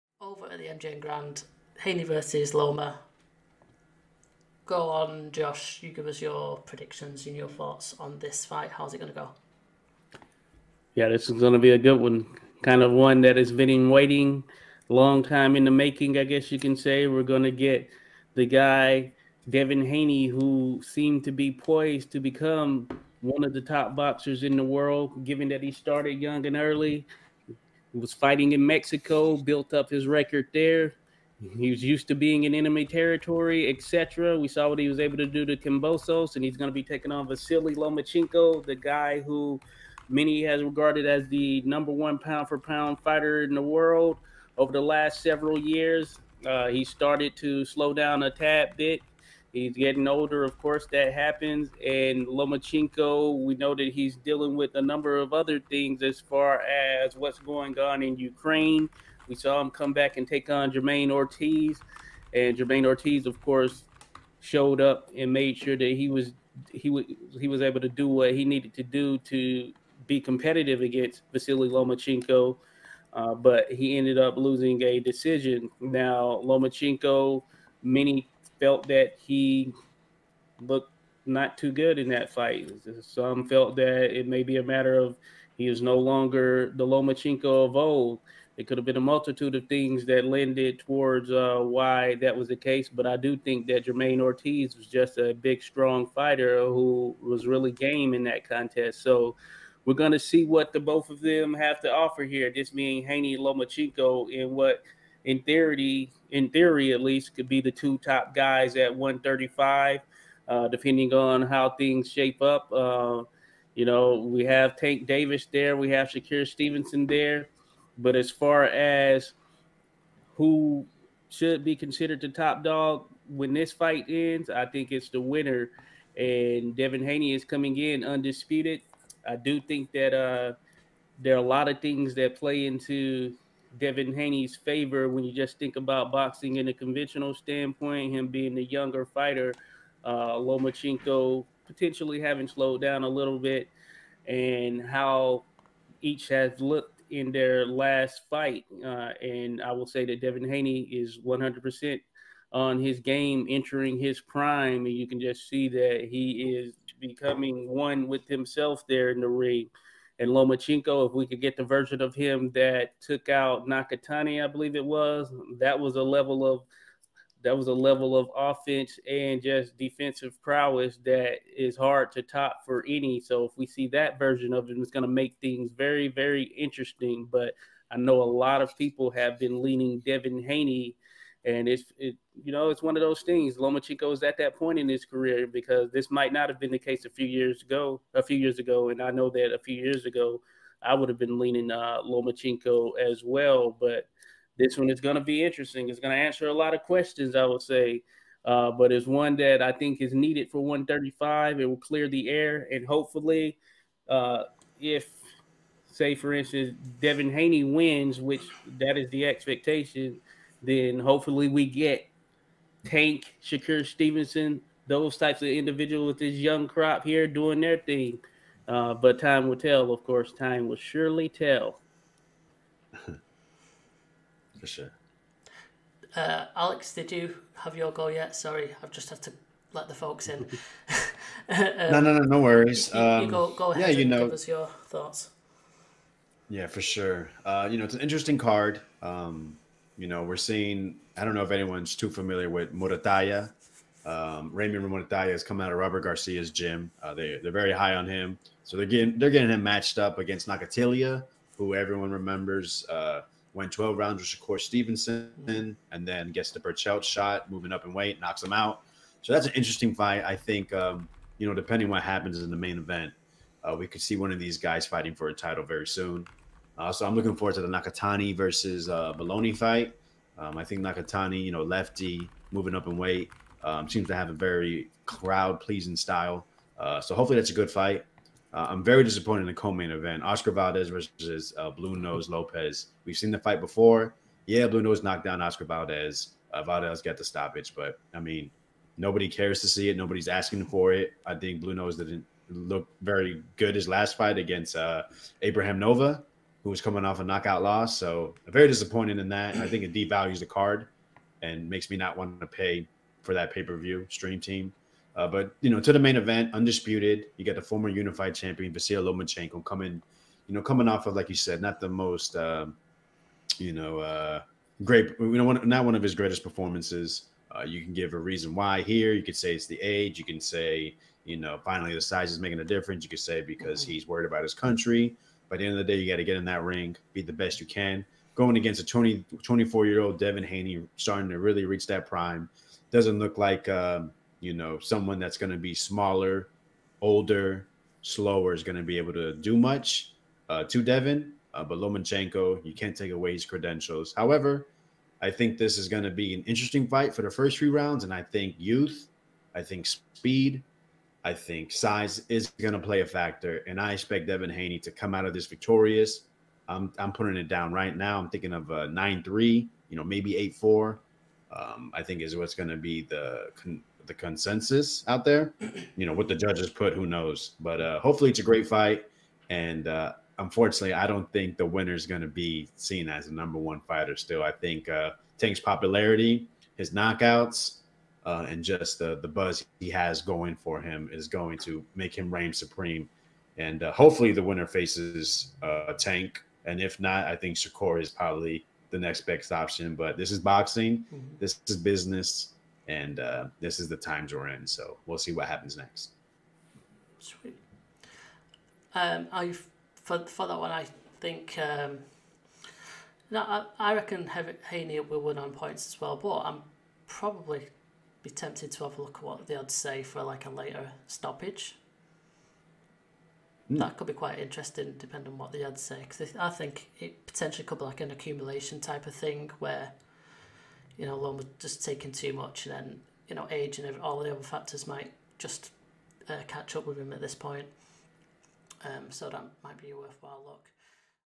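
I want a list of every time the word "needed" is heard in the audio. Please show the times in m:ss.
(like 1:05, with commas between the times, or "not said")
1:08, 3:20.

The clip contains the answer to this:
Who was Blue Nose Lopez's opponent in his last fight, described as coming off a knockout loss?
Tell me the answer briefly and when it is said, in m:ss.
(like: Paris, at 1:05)
Abraham Nova, at 4:55.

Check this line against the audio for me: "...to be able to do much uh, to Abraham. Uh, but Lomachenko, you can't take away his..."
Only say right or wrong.
wrong.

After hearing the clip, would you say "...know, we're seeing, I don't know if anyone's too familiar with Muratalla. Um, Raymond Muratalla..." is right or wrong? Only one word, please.
right.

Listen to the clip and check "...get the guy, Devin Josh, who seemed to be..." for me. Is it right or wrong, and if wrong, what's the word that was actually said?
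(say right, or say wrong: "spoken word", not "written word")
wrong: "Haney", not "Josh".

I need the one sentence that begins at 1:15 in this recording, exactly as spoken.
Now Lomachenko, many felt that he looked not too good in that fight.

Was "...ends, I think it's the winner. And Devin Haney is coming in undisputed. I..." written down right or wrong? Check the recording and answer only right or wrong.
right.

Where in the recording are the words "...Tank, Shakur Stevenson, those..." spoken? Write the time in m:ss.
3:32.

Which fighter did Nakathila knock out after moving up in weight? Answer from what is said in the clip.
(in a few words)
Berchelt.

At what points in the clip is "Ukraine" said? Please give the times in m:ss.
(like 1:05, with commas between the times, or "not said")
0:58.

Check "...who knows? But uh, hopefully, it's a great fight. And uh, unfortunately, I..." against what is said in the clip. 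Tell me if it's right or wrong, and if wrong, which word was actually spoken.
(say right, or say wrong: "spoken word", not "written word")
right.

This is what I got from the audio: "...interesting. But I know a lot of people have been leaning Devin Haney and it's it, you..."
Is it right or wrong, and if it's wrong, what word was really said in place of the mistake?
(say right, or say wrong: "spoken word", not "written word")
right.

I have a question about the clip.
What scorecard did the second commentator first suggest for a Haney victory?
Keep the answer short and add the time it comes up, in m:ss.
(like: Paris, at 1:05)
9-3, at 5:58.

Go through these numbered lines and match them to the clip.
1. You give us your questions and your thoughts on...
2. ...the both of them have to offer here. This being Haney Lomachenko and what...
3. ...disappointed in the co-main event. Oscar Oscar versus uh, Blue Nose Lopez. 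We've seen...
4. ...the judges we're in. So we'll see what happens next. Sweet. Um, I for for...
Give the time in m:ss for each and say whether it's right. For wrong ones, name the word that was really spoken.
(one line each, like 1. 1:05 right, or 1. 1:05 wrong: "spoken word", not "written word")
1. 0:05 wrong: "predictions", not "questions"
2. 1:40 right
3. 4:39 wrong: "Valdez", not "Oscar"
4. 6:33 wrong: "times", not "judges".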